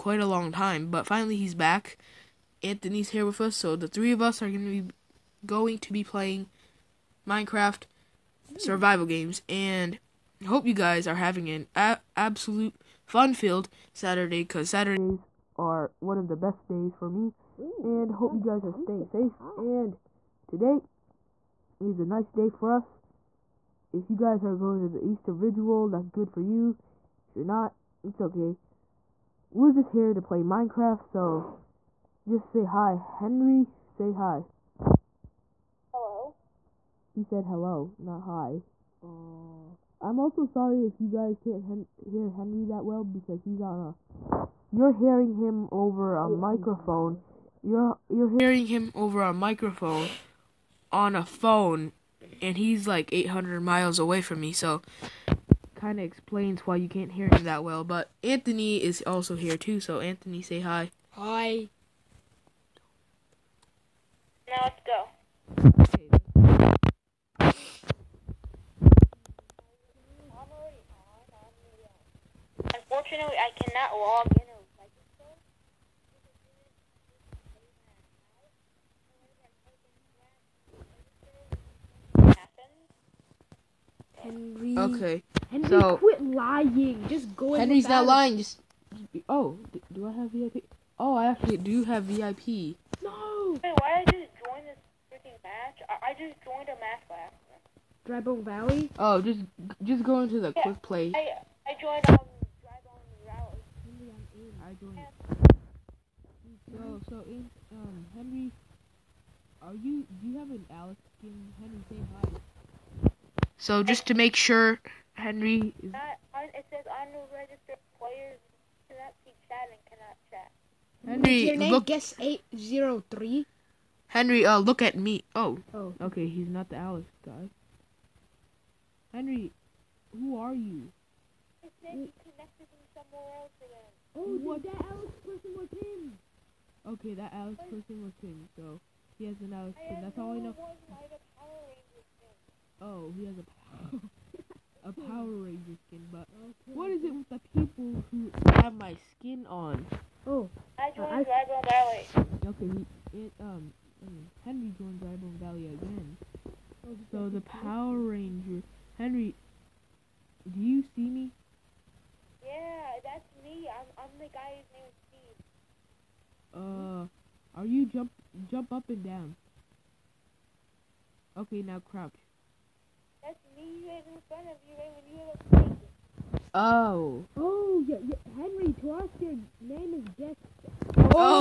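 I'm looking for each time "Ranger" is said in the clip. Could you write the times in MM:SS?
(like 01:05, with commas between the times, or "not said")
02:25, 02:37.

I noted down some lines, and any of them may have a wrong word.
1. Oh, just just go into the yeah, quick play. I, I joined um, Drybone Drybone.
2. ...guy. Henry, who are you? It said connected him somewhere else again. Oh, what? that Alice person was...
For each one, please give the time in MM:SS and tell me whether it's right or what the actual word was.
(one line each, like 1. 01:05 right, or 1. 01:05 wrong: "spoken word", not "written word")
1. 01:38 wrong: "Valley", not "Drybone"
2. 02:07 right.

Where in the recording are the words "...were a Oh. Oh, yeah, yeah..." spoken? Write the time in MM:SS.
02:55.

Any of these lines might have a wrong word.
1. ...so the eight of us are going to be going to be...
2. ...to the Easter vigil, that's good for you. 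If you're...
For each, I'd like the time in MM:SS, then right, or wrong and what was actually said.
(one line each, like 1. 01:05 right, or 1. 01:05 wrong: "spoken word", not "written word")
1. 00:03 wrong: "three", not "eight"
2. 00:24 right.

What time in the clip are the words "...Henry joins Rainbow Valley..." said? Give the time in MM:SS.
02:34.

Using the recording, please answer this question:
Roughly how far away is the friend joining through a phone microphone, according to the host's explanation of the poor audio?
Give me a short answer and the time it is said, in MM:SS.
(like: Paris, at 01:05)
800 miles, at 00:53.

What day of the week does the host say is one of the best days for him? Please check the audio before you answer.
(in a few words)
Saturday.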